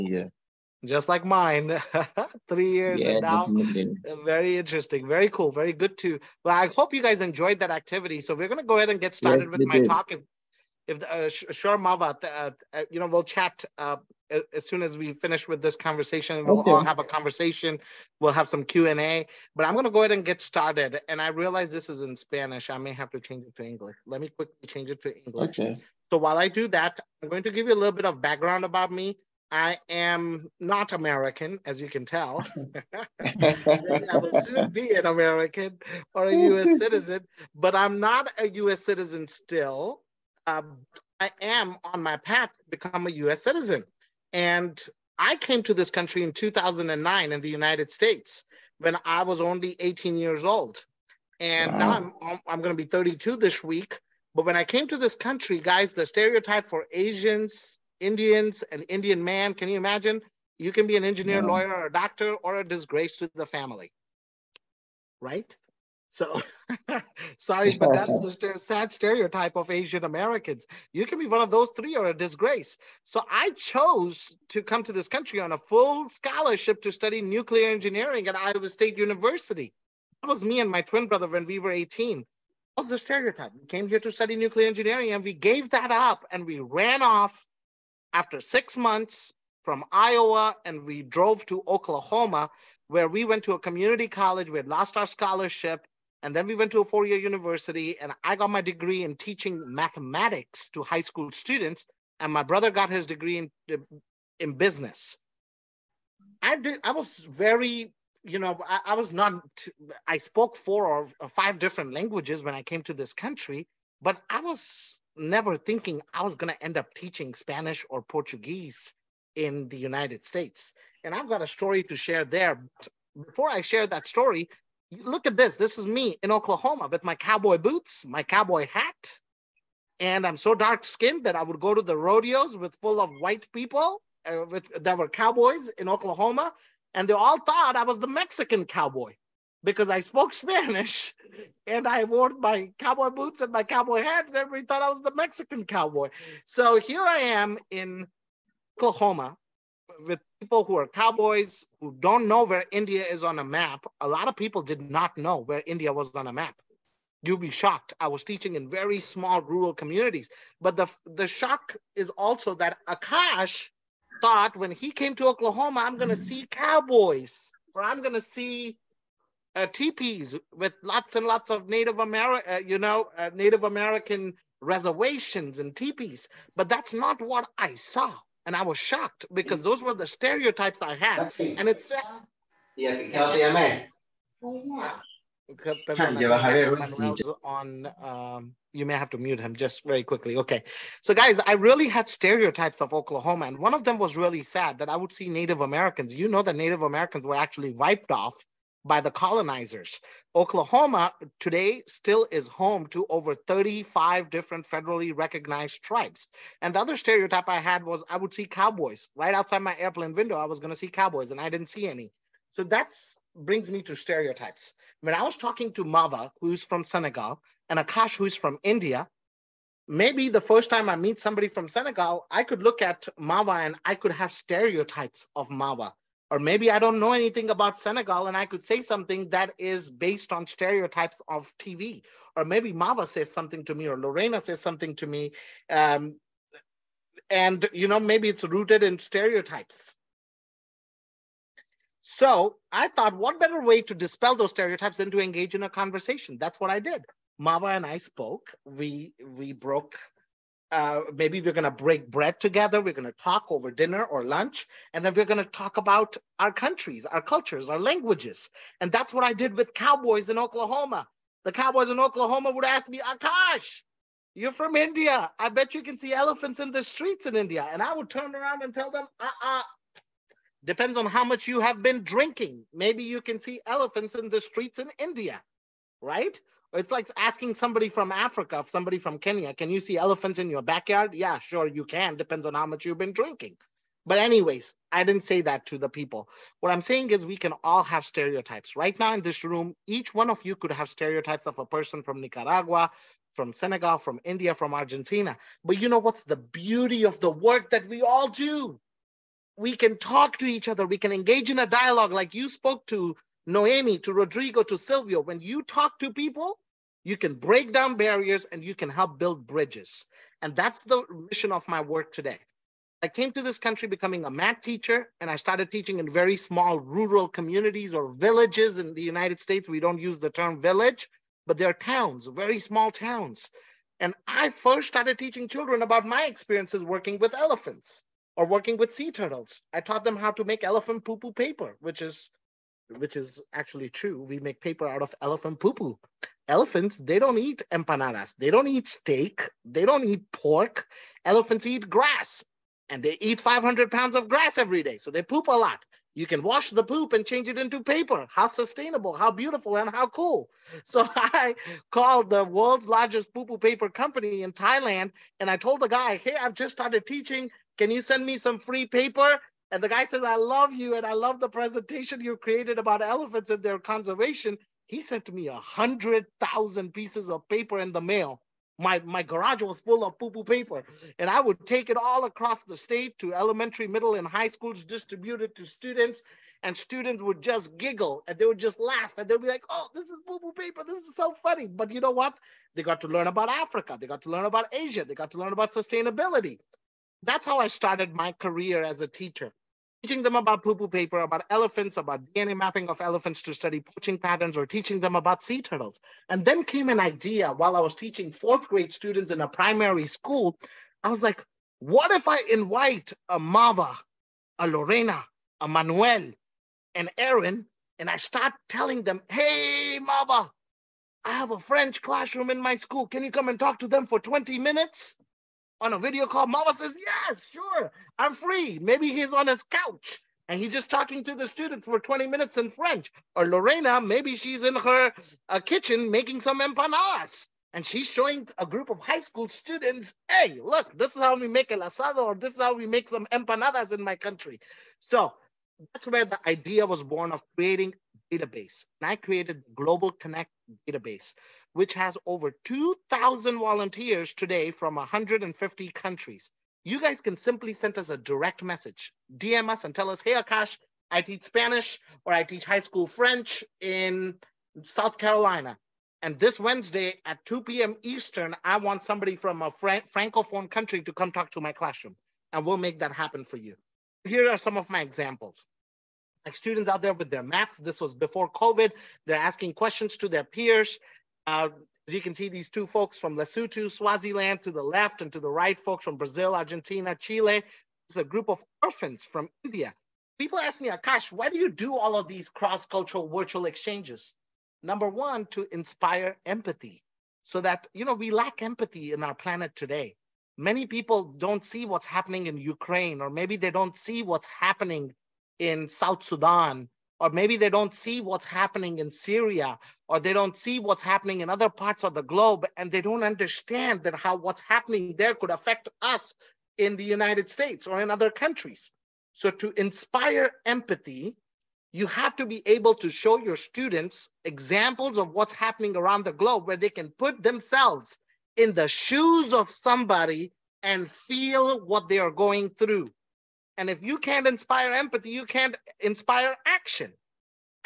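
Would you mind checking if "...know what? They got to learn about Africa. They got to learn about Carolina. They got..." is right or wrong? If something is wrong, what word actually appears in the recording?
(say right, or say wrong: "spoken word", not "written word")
wrong: "Asia", not "Carolina".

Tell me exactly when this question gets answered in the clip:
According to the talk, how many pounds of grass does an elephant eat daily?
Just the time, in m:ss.
5:43.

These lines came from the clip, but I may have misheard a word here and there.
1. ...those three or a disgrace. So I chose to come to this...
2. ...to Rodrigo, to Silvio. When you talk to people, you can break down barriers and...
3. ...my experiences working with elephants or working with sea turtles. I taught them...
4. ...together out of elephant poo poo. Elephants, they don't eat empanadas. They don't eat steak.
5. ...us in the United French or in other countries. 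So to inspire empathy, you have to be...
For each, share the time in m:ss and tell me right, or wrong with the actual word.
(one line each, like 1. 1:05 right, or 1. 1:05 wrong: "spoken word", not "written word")
1. 1:11 right
2. 5:03 right
3. 5:26 right
4. 5:34 wrong: "paper", not "together"
5. 8:26 wrong: "States", not "French".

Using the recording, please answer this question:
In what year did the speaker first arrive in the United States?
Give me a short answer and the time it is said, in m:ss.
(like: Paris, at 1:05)
2009, at 0:46.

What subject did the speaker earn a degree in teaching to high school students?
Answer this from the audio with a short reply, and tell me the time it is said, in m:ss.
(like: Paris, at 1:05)
mathematics, at 1:39.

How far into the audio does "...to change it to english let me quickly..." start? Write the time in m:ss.
0:23.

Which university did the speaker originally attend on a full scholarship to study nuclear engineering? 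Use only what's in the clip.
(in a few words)
Iowa State University.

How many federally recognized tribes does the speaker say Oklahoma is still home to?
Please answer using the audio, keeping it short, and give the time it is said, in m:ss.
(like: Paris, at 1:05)
over 35, at 3:23.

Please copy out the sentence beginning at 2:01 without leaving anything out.
And I've got a story to share there.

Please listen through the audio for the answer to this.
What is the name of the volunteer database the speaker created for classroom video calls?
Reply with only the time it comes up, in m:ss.
7:19.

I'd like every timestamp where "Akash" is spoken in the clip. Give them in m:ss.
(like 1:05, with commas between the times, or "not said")
2:42, 3:37, 4:22, 7:30, 8:00.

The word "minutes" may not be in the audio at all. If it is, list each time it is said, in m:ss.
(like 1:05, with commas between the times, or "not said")
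6:54, 7:02.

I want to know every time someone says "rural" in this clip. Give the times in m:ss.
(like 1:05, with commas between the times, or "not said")
2:39, 5:16.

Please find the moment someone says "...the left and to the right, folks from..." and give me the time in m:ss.
7:54.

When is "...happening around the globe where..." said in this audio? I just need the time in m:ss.
8:35.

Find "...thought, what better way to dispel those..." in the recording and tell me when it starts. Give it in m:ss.
4:02.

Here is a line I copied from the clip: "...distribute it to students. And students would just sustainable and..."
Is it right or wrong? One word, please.
wrong.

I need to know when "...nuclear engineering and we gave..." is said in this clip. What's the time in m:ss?
1:24.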